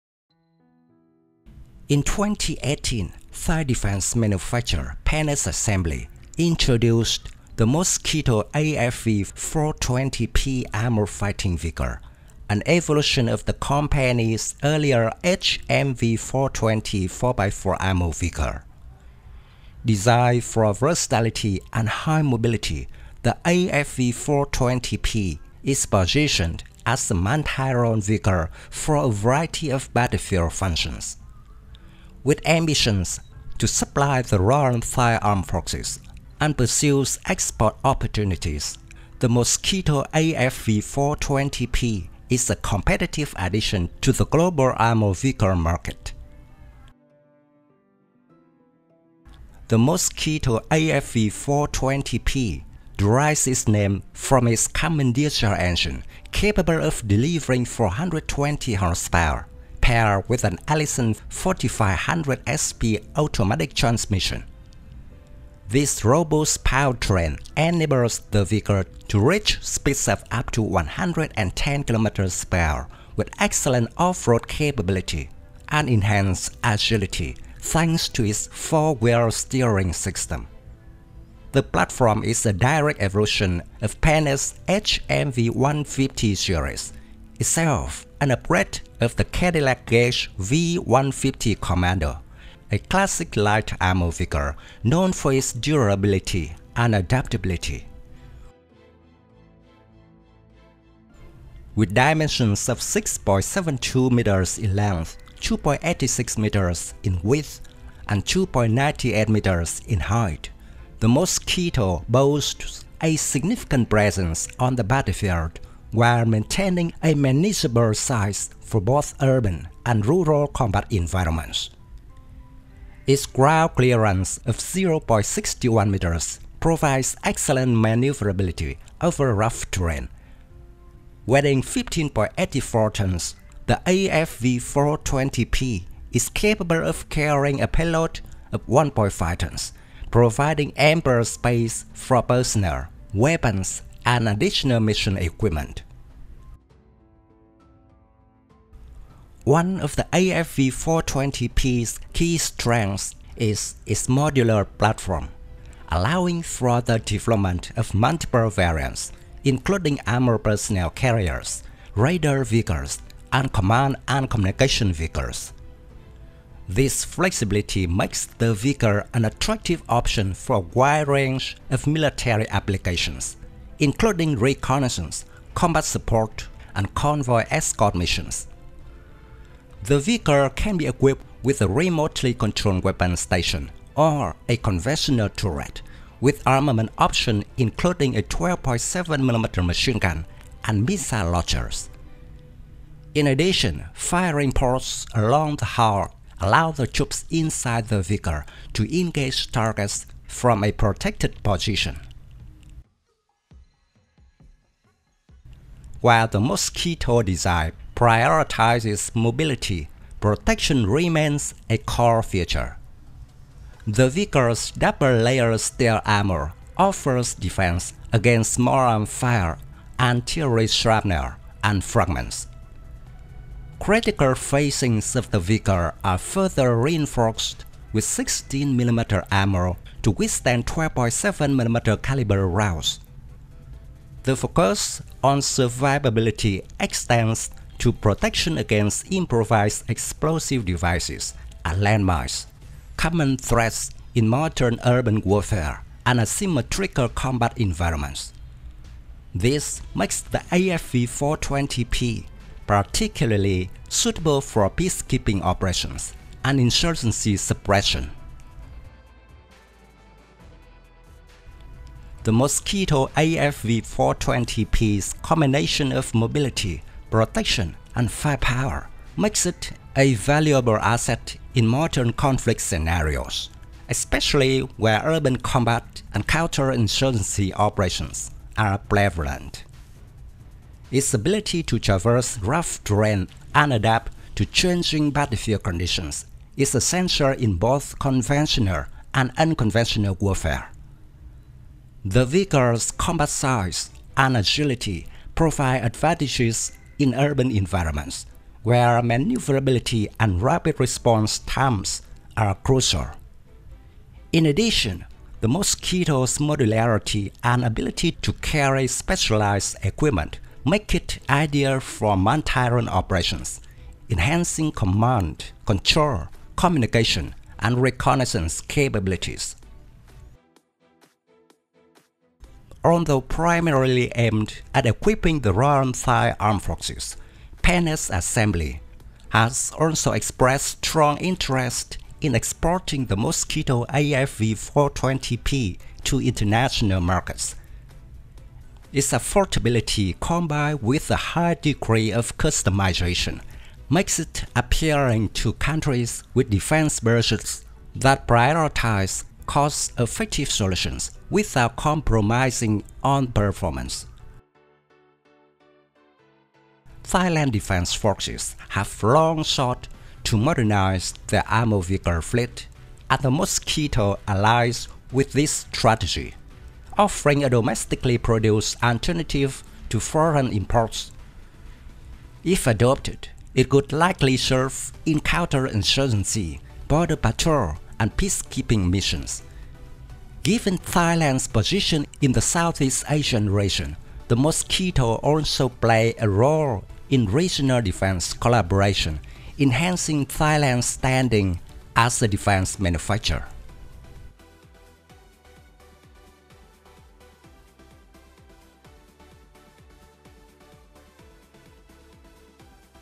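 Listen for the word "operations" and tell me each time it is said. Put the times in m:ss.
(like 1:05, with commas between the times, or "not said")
4:15, 4:37, 5:12.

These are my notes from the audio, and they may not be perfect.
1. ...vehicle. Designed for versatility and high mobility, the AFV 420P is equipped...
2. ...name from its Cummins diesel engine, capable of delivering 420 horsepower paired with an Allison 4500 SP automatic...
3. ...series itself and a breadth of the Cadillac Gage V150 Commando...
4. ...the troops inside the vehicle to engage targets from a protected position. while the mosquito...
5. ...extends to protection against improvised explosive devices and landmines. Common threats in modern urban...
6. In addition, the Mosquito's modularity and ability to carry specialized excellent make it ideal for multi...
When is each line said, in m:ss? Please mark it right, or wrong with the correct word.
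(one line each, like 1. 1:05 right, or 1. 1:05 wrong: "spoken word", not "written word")
1. 0:18 wrong: "positioned", not "equipped"
2. 0:53 right
3. 1:26 right
4. 3:16 right
5. 3:56 right
6. 5:04 wrong: "equipment", not "excellent".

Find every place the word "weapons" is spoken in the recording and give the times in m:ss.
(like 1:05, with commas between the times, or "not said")
2:23, 3:02.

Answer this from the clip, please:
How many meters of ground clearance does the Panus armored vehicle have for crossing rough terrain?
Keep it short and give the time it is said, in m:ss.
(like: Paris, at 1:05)
0.61, at 2:04.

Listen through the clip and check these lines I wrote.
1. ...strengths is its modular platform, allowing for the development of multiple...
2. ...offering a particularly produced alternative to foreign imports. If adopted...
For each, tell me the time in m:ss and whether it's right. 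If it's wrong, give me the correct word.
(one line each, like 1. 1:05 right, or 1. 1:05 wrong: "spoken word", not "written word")
1. 2:32 right
2. 6:06 wrong: "domestically", not "particularly".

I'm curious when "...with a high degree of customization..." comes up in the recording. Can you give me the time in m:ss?
5:40.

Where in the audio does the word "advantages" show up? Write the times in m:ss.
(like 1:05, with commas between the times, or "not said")
4:55.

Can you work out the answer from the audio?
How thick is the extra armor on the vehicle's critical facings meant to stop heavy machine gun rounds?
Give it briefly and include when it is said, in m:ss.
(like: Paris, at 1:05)
16mm, at 3:48.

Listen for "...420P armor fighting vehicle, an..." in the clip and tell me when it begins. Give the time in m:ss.
0:09.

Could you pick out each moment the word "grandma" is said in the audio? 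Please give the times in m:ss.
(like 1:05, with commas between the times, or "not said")
not said.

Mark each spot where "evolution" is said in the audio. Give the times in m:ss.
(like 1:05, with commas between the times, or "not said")
0:12, 1:23.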